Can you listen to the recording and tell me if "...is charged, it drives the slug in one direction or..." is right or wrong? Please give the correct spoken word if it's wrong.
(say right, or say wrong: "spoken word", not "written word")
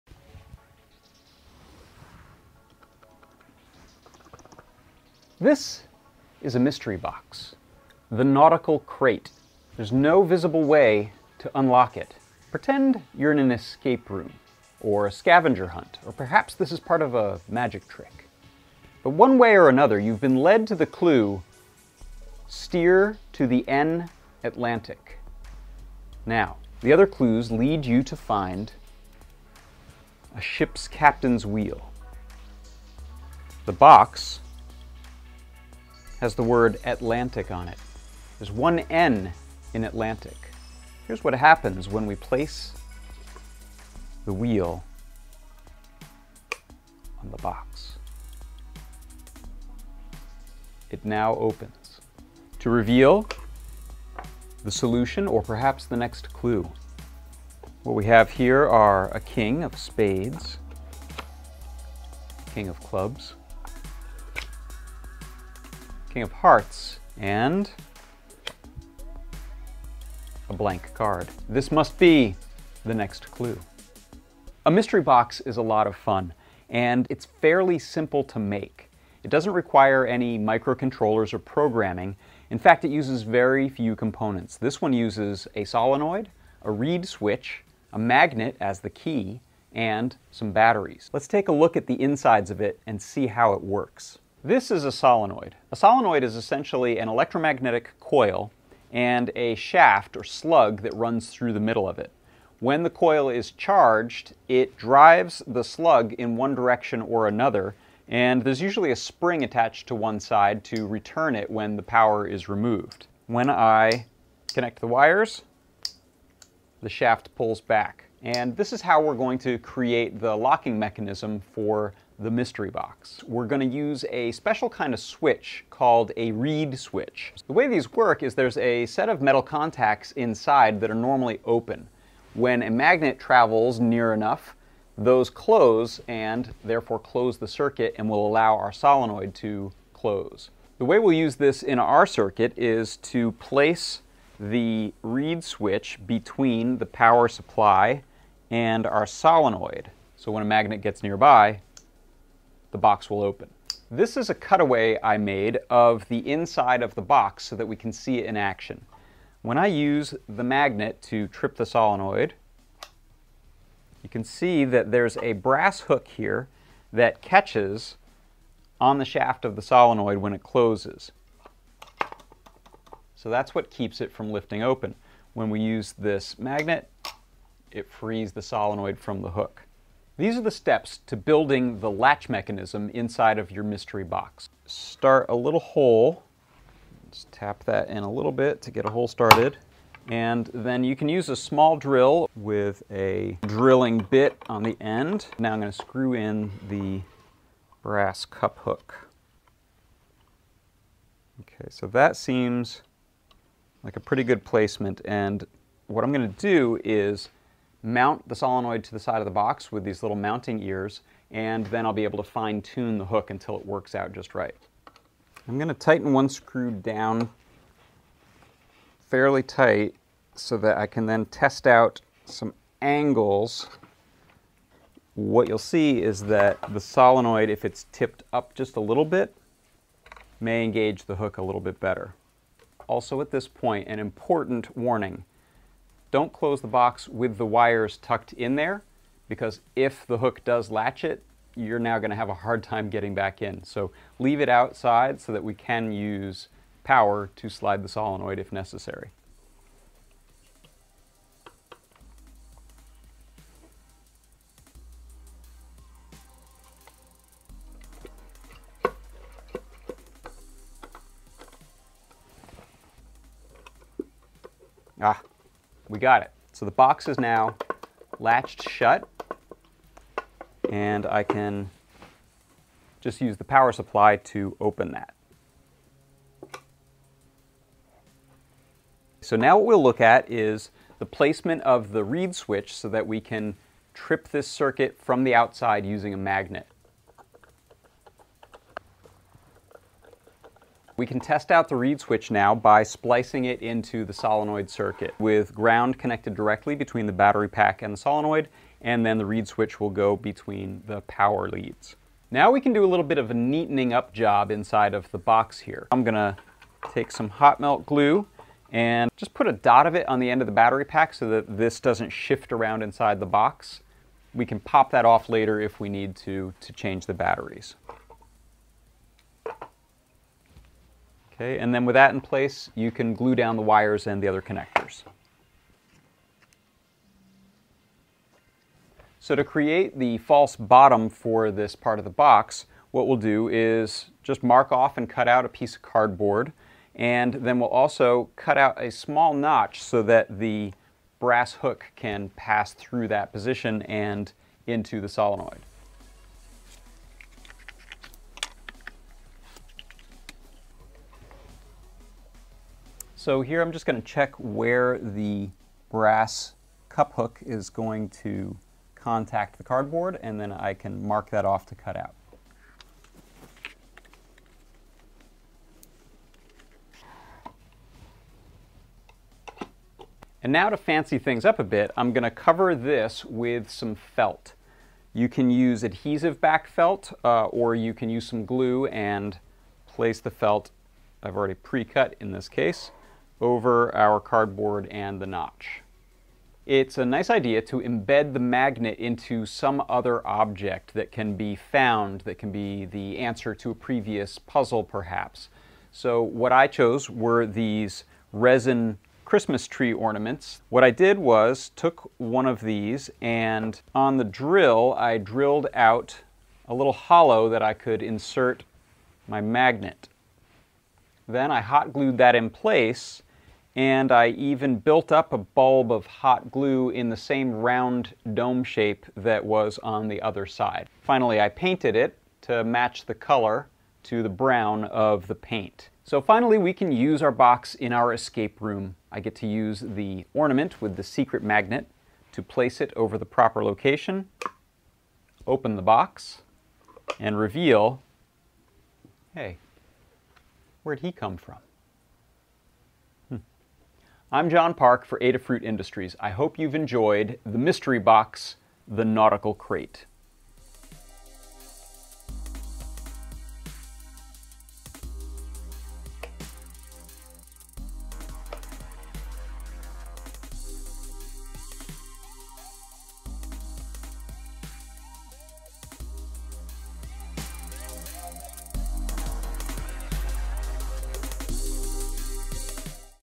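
right.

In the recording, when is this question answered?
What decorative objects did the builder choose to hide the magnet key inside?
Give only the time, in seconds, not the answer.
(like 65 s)
398 s.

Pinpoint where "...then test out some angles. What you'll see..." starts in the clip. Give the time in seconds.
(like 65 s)
221 s.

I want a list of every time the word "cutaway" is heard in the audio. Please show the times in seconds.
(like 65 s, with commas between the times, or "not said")
154 s.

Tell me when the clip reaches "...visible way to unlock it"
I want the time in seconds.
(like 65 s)
10 s.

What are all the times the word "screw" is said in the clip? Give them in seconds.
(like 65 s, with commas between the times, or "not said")
195 s, 216 s.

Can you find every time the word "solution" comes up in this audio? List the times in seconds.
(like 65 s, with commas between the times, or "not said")
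54 s.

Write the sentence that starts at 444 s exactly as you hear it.
I'm John Park for Adafruit Industries.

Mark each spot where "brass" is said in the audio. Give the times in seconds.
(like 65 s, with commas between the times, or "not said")
165 s, 197 s, 341 s, 355 s.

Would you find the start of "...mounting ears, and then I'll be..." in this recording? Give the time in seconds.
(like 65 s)
210 s.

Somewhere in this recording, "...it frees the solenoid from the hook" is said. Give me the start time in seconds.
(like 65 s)
177 s.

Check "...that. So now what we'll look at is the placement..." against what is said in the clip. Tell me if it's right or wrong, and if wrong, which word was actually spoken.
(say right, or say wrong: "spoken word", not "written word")
right.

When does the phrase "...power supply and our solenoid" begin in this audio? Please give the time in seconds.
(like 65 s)
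146 s.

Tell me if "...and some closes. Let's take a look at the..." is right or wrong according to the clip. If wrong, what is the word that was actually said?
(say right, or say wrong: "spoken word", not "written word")
wrong: "batteries", not "closes".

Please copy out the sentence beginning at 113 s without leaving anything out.
When I connect the wires, the shaft pulls back.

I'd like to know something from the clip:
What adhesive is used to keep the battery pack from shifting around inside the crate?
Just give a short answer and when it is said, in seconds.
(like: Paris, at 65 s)
Hot melt glue, at 307 s.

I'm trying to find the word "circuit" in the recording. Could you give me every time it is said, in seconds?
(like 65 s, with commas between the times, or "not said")
137 s, 142 s, 284 s, 294 s.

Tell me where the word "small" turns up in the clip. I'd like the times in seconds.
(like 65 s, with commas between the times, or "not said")
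191 s, 338 s.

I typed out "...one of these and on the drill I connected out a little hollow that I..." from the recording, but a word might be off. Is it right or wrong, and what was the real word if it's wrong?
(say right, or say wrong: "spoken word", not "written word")
wrong: "drilled", not "connected".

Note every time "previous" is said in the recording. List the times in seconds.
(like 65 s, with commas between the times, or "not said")
393 s.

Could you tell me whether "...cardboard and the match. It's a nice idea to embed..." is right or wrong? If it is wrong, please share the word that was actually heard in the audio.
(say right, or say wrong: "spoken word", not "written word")
wrong: "notch", not "match".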